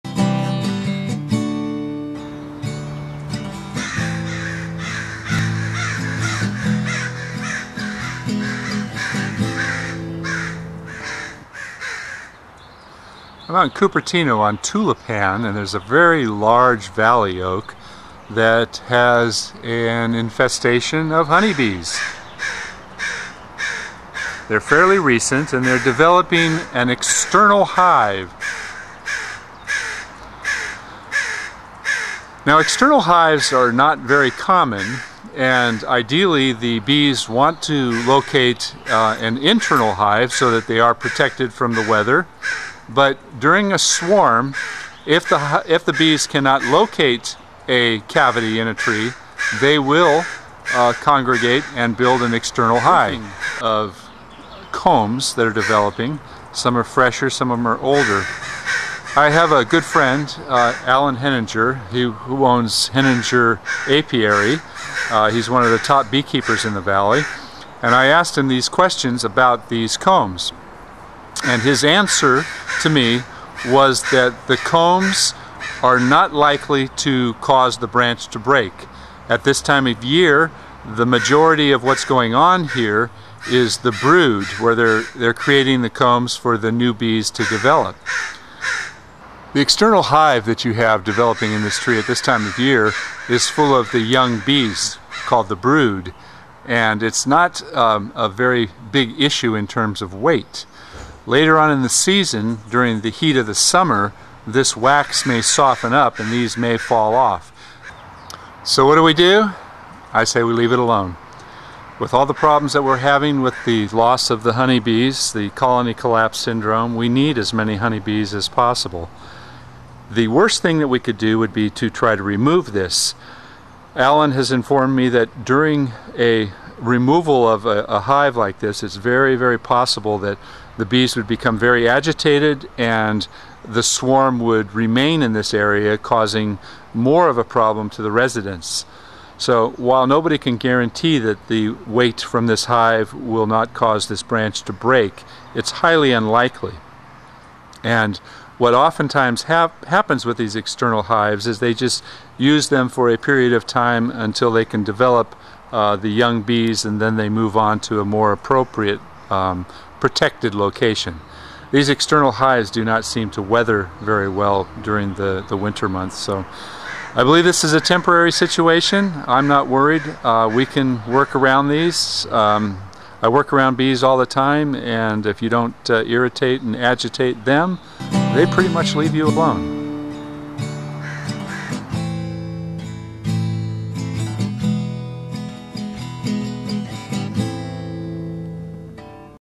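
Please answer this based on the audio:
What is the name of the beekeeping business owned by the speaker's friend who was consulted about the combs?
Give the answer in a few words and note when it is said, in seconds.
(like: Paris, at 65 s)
Henninger Apiary, at 62 s.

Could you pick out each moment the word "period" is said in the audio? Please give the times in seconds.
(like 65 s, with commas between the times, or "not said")
153 s.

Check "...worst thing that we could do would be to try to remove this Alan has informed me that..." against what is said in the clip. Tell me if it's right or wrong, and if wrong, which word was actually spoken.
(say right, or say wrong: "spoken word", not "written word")
right.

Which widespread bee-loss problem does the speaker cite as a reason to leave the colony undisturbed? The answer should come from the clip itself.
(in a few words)
colony collapse syndrome.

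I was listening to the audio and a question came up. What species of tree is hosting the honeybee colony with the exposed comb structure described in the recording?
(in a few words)
valley oak.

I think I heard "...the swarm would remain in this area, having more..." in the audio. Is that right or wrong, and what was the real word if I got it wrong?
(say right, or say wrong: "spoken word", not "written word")
wrong: "causing", not "having".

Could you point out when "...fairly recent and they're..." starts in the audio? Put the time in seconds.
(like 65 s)
24 s.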